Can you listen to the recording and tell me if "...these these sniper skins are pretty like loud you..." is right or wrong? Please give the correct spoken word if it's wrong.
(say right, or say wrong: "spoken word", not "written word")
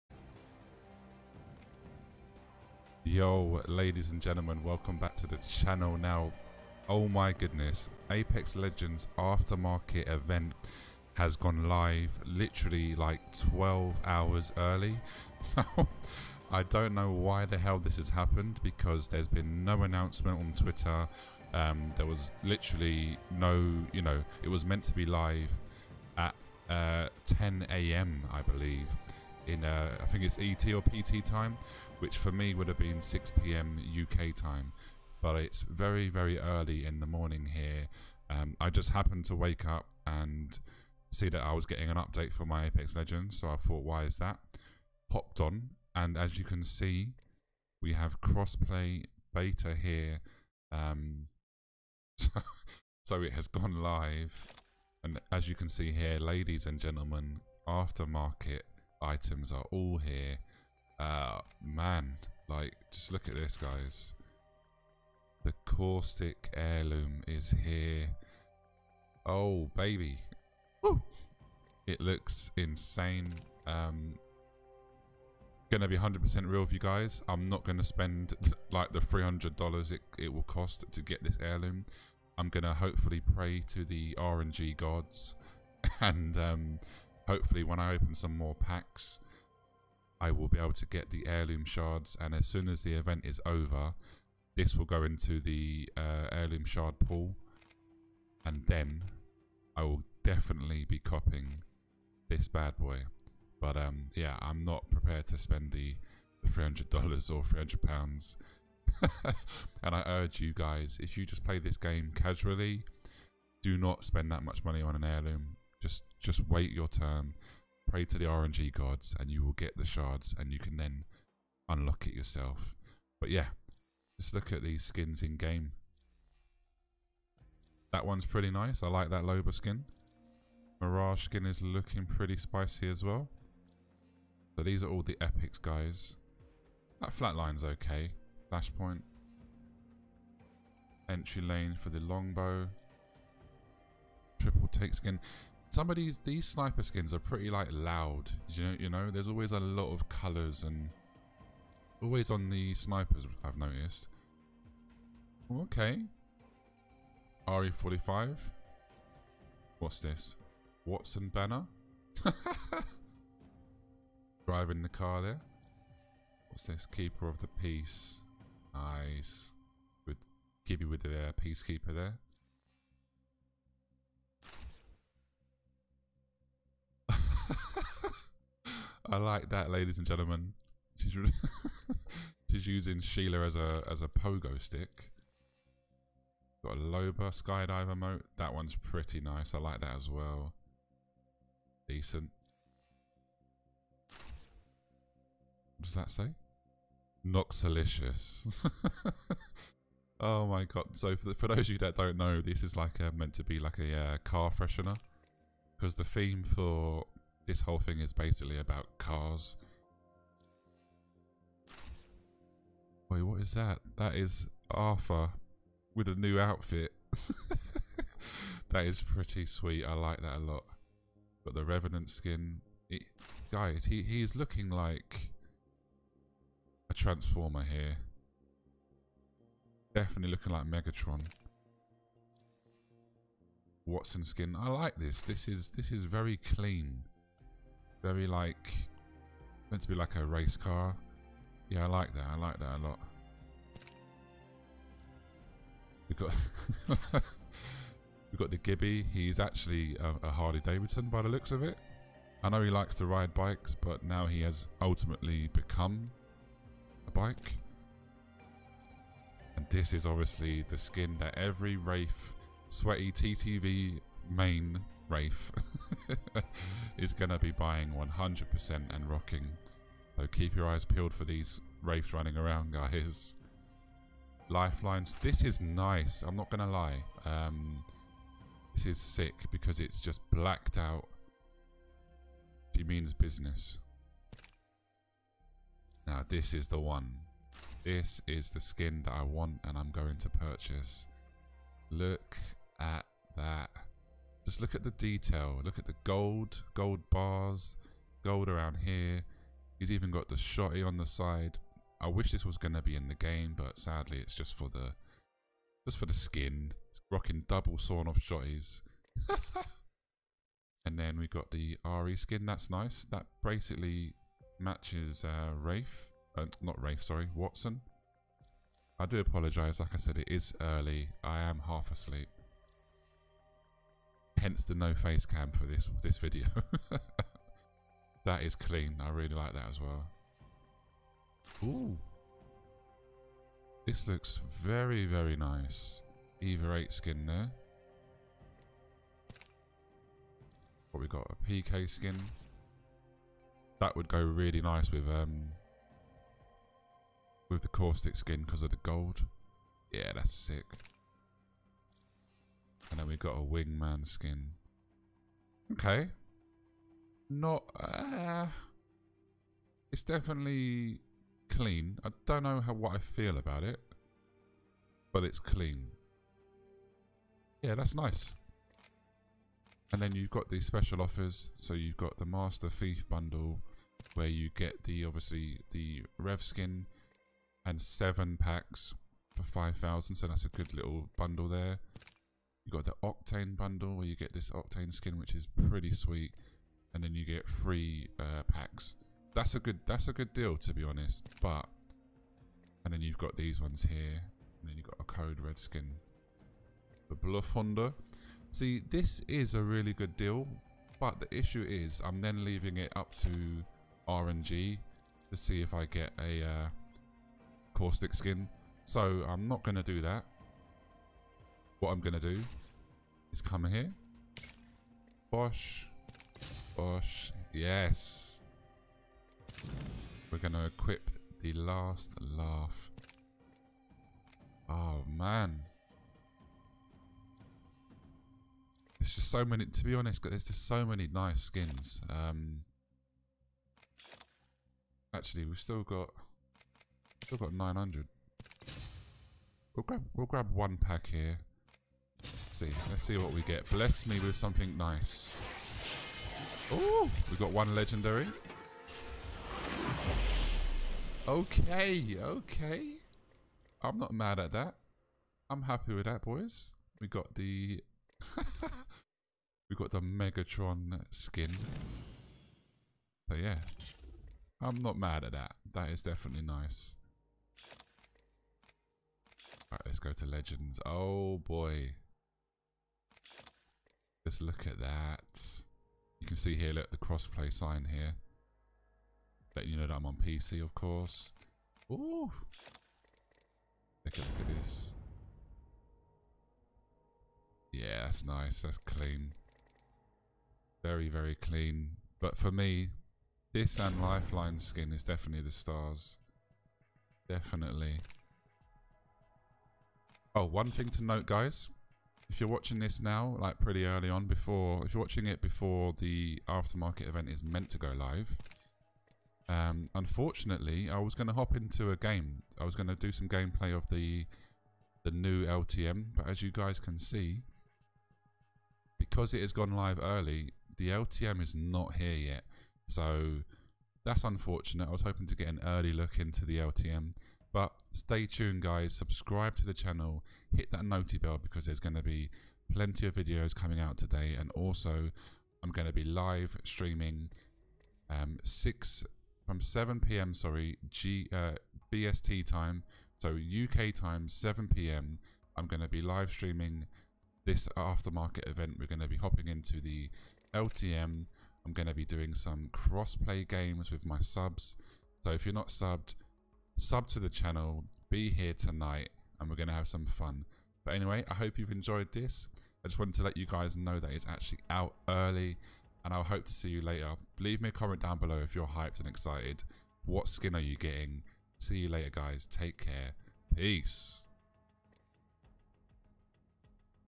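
right.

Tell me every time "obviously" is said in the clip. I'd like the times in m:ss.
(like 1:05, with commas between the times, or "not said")
4:20, 6:15.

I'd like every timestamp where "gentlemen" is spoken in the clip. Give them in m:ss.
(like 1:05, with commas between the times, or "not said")
0:04, 0:56, 3:00.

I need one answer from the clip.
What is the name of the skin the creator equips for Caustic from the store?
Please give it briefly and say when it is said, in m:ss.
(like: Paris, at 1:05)
Last Laugh, at 7:01.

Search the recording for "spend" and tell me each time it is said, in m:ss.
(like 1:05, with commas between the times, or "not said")
1:17, 1:45, 1:54.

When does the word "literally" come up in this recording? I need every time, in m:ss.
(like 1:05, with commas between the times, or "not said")
0:12, 0:22.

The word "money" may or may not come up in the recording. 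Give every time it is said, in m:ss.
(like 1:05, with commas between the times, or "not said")
1:54.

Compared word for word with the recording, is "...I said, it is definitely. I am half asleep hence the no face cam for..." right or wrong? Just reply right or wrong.
wrong.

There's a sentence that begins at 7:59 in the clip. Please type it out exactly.
Letting you know that I'm on PC, of course.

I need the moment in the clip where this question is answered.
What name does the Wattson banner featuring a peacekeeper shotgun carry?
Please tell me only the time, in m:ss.
2:46.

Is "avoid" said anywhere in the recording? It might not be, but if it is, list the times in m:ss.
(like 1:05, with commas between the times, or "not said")
not said.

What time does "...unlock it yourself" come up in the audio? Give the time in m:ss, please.
2:01.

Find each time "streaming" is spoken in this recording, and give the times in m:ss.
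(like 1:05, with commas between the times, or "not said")
8:56, 9:06.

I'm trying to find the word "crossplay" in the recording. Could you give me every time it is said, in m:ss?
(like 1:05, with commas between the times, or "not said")
0:48, 7:56, 9:12.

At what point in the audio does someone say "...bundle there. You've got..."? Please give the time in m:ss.
6:21.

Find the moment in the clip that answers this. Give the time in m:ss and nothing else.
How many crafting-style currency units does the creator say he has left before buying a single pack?
7:17.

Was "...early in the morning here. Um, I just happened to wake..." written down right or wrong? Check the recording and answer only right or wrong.
right.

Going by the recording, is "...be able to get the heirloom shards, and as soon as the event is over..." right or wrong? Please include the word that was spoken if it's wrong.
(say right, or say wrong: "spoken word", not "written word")
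right.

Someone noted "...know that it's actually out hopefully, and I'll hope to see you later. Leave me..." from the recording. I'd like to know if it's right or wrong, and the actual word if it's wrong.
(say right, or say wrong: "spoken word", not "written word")
wrong: "early", not "hopefully".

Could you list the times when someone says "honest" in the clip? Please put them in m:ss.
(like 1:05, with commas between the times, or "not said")
6:30, 7:09.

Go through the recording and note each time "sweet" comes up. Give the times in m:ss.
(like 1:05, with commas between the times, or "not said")
3:39, 6:25.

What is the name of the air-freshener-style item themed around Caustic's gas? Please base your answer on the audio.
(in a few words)
Noxalicious.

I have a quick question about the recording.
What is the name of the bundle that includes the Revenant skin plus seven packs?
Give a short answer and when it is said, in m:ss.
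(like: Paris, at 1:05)
Master Thief bundle, at 6:12.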